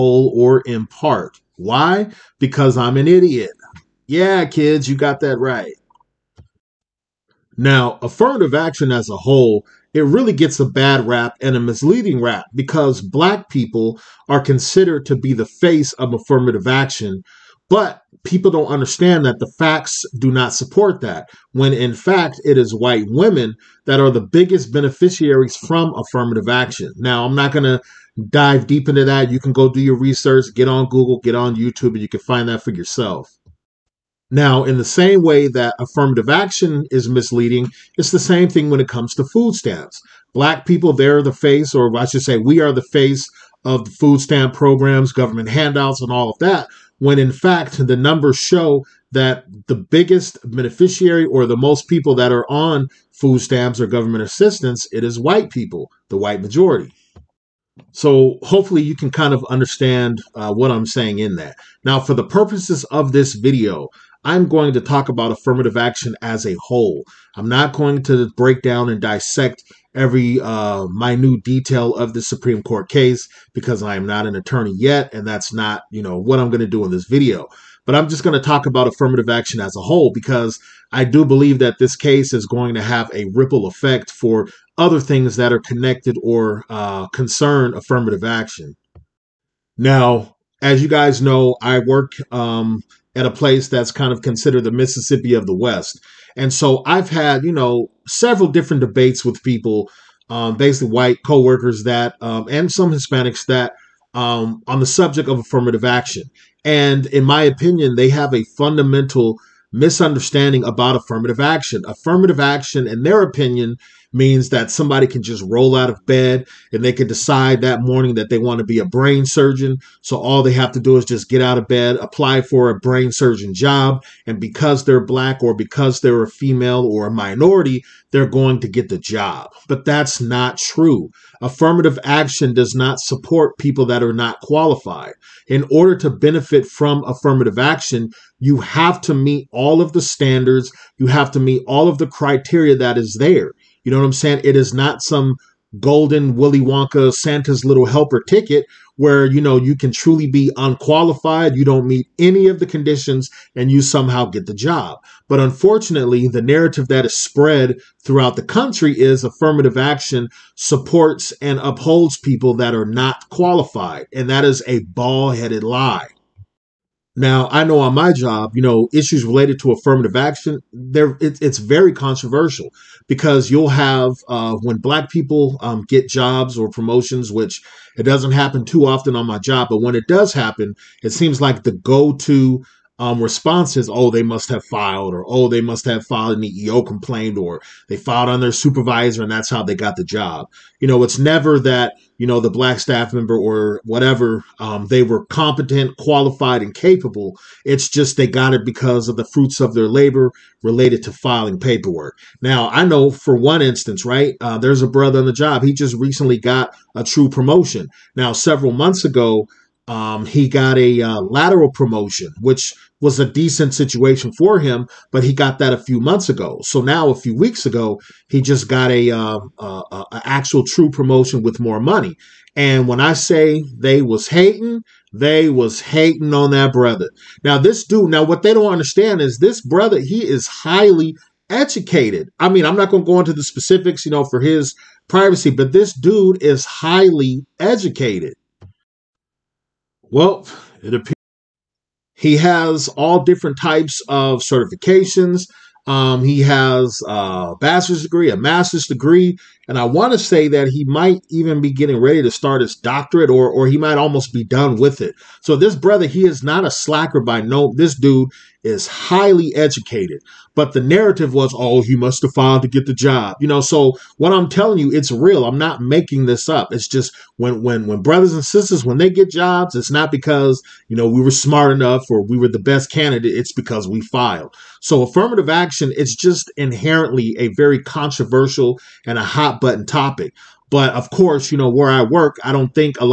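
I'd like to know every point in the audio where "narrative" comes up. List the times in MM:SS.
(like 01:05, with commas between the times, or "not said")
02:36, 04:20.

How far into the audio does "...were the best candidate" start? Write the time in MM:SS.
04:32.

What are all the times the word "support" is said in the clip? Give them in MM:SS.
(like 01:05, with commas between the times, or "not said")
00:20, 02:12, 02:40.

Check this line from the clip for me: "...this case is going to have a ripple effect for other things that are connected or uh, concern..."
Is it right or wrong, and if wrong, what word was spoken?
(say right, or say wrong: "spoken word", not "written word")
right.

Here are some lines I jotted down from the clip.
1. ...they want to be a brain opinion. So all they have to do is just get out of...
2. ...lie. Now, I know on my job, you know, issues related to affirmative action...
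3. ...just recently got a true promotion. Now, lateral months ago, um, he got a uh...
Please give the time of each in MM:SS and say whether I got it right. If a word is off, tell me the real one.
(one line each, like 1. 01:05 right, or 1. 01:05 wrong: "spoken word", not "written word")
1. 01:58 wrong: "surgeon", not "opinion"
2. 02:45 right
3. 03:25 wrong: "several", not "lateral".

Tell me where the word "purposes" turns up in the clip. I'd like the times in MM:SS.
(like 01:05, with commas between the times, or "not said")
01:02.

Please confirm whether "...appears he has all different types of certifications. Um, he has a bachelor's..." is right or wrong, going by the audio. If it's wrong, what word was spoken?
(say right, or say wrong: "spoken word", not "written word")
right.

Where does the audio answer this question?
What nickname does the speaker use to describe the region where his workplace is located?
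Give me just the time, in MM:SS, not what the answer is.
01:34.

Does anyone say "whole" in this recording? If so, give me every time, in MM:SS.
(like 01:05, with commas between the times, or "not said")
00:09, 01:06, 01:19.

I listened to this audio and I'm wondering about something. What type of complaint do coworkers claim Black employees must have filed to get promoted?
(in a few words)
EEO complaint.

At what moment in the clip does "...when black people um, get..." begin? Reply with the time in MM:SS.
02:54.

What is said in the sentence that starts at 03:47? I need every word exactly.
Now this dude, now what they don't understand is this brother, he is highly educated.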